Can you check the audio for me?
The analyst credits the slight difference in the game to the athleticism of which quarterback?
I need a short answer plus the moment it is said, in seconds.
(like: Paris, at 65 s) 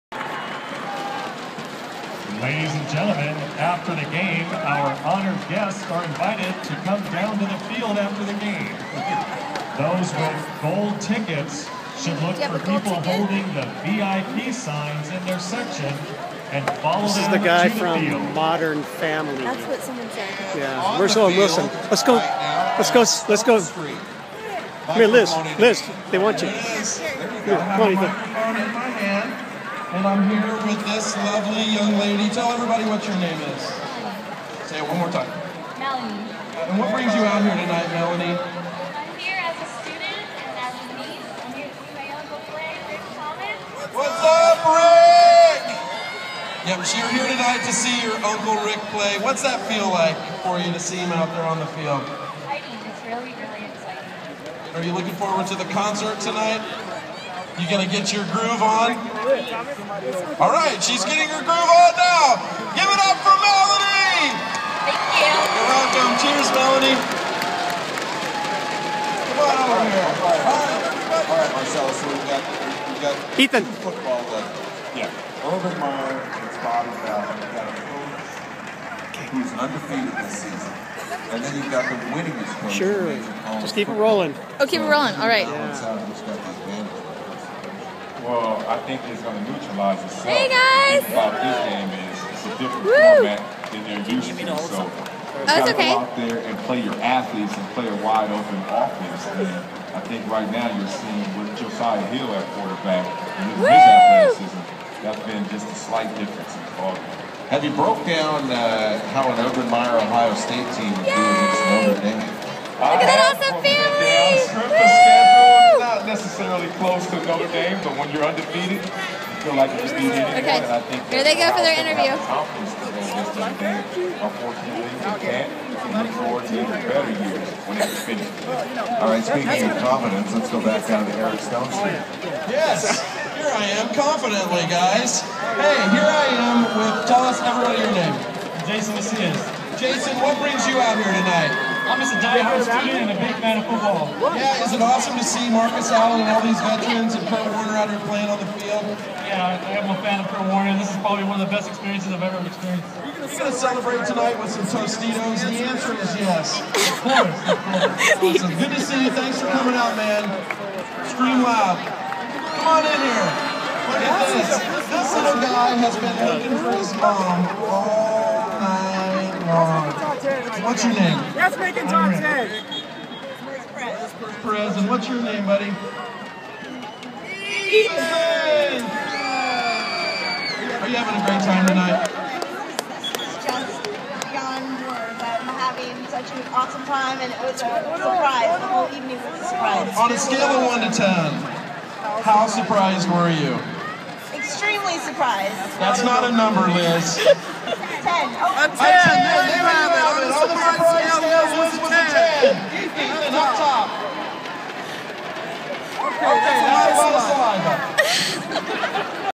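Josiah Hill, at 101 s.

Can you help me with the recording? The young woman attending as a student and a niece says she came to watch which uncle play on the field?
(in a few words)
Rick Thomas.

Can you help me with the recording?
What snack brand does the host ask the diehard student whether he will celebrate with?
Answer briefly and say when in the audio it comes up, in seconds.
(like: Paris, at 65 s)
Tostitos, at 154 s.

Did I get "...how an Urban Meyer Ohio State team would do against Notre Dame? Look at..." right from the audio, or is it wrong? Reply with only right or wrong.
right.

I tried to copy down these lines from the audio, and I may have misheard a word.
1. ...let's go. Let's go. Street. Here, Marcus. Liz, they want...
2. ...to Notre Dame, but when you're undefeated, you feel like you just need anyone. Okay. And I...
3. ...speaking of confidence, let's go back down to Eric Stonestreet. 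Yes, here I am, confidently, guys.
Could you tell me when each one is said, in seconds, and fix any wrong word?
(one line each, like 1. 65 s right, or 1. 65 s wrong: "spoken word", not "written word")
1. 22 s wrong: "Liz", not "Marcus"
2. 117 s right
3. 129 s right.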